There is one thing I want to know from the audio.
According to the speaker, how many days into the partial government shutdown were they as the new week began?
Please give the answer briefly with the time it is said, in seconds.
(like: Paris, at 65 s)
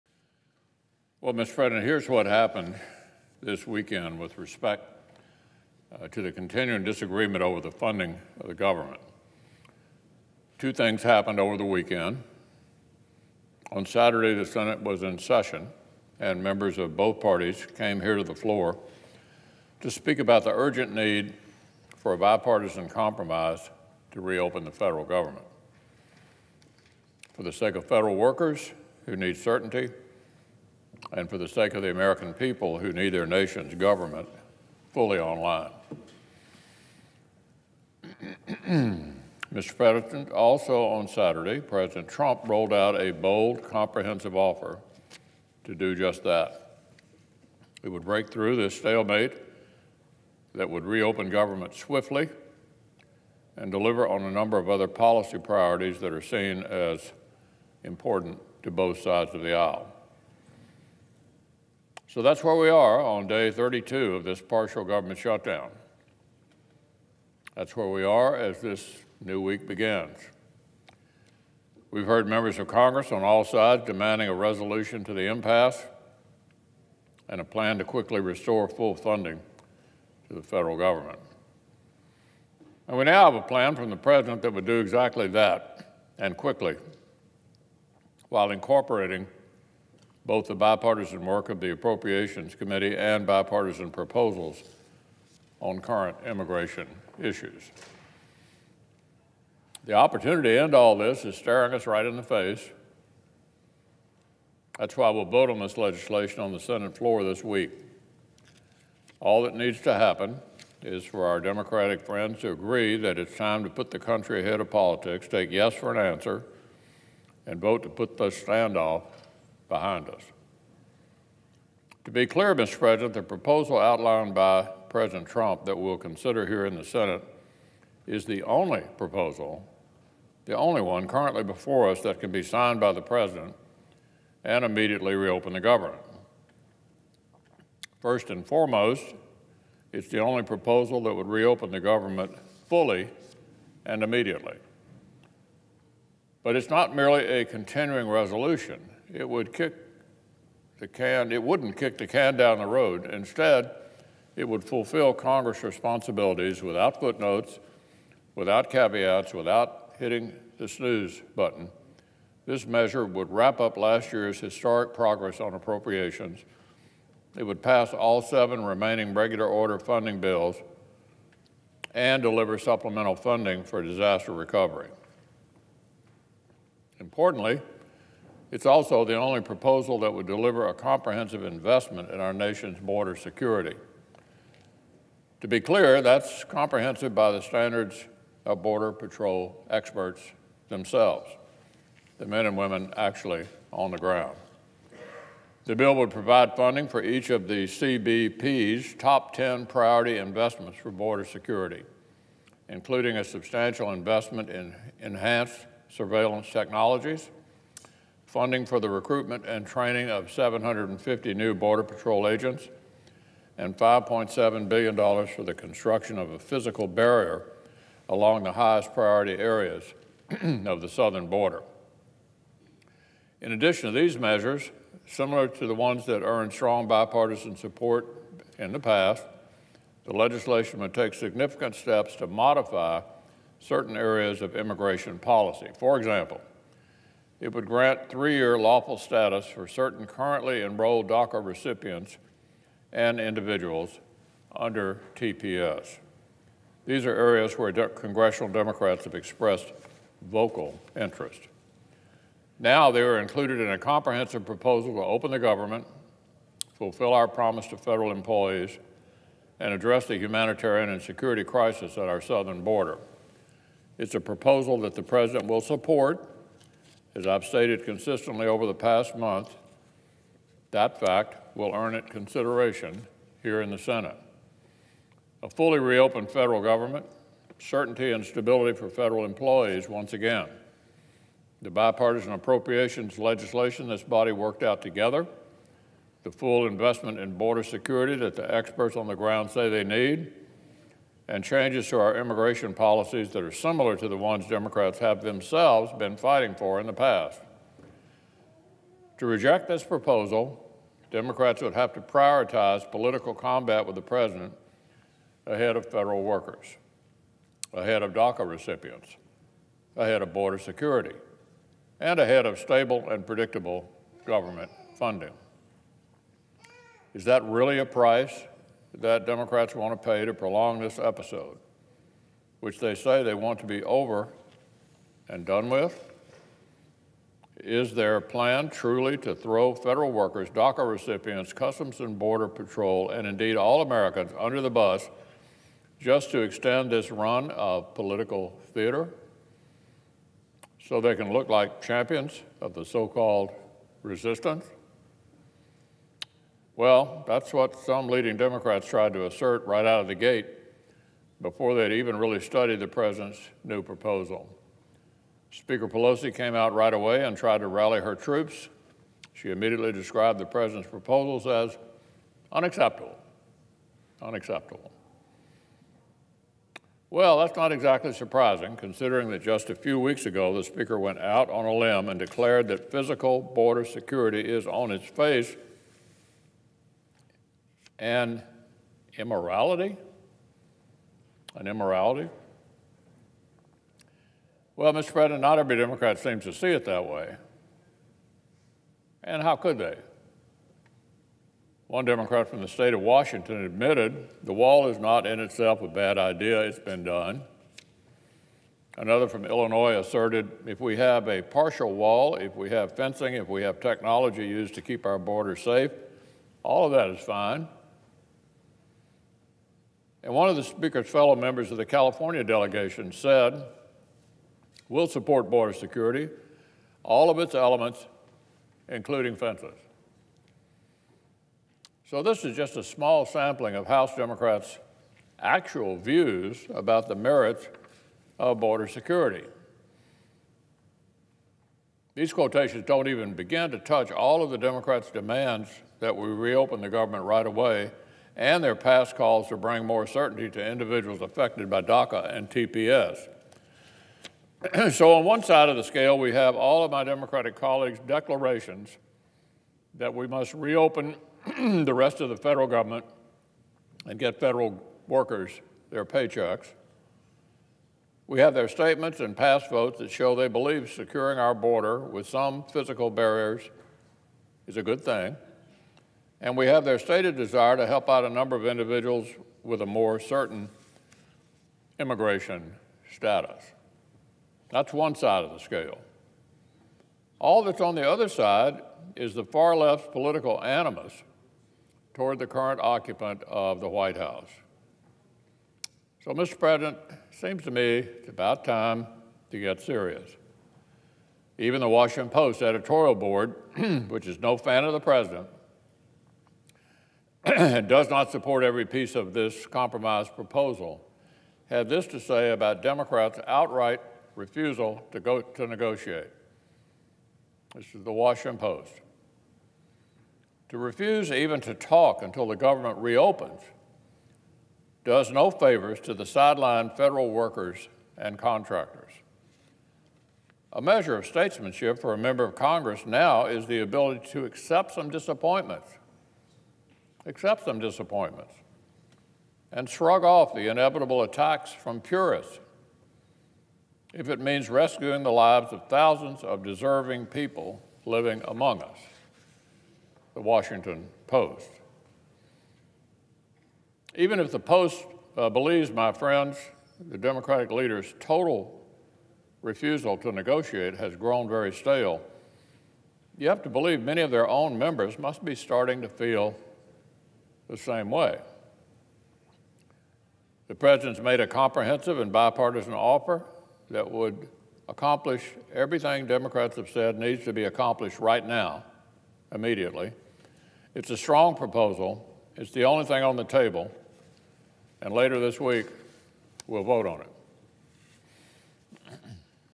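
32, at 63 s.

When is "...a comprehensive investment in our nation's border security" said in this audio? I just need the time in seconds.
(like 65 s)
180 s.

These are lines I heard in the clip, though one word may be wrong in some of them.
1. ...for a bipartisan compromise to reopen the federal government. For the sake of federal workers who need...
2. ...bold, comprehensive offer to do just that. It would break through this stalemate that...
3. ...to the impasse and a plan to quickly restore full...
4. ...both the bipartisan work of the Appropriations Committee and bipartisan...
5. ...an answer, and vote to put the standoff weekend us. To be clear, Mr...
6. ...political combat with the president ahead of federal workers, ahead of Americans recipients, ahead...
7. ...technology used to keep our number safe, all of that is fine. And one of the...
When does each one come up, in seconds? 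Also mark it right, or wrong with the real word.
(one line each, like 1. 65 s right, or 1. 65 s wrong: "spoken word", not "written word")
1. 21 s right
2. 43 s right
3. 75 s right
4. 90 s right
5. 115 s wrong: "behind", not "weekend"
6. 302 s wrong: "DACA", not "Americans"
7. 403 s wrong: "border", not "number".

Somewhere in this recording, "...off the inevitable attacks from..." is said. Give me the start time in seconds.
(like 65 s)
530 s.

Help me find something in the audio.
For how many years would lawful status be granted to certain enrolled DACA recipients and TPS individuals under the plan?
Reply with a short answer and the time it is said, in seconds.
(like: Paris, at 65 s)
3, at 238 s.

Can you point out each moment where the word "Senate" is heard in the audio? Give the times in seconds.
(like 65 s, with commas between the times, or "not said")
14 s, 106 s, 126 s, 273 s.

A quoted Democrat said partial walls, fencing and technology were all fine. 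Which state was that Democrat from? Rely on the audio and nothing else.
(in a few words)
Illinois.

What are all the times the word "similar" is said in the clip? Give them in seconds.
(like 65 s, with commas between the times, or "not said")
225 s, 293 s.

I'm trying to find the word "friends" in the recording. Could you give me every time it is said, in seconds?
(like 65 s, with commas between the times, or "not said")
111 s, 546 s.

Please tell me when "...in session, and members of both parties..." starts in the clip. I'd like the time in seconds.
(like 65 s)
15 s.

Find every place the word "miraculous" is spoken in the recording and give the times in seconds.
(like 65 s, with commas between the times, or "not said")
not said.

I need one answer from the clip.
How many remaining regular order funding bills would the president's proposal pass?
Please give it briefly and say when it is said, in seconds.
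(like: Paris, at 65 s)
7, at 168 s.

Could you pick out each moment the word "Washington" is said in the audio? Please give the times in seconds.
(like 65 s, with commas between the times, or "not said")
393 s, 491 s, 508 s, 540 s.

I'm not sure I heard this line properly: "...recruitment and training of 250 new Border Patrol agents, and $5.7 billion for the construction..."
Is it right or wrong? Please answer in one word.
wrong.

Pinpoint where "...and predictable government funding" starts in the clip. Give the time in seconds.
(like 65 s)
313 s.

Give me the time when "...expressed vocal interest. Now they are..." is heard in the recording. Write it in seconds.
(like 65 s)
249 s.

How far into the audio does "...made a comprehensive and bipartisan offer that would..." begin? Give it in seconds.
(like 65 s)
561 s.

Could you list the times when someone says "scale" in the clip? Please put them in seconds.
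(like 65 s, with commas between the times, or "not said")
445 s, 475 s.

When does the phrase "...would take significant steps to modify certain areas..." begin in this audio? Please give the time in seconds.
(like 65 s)
230 s.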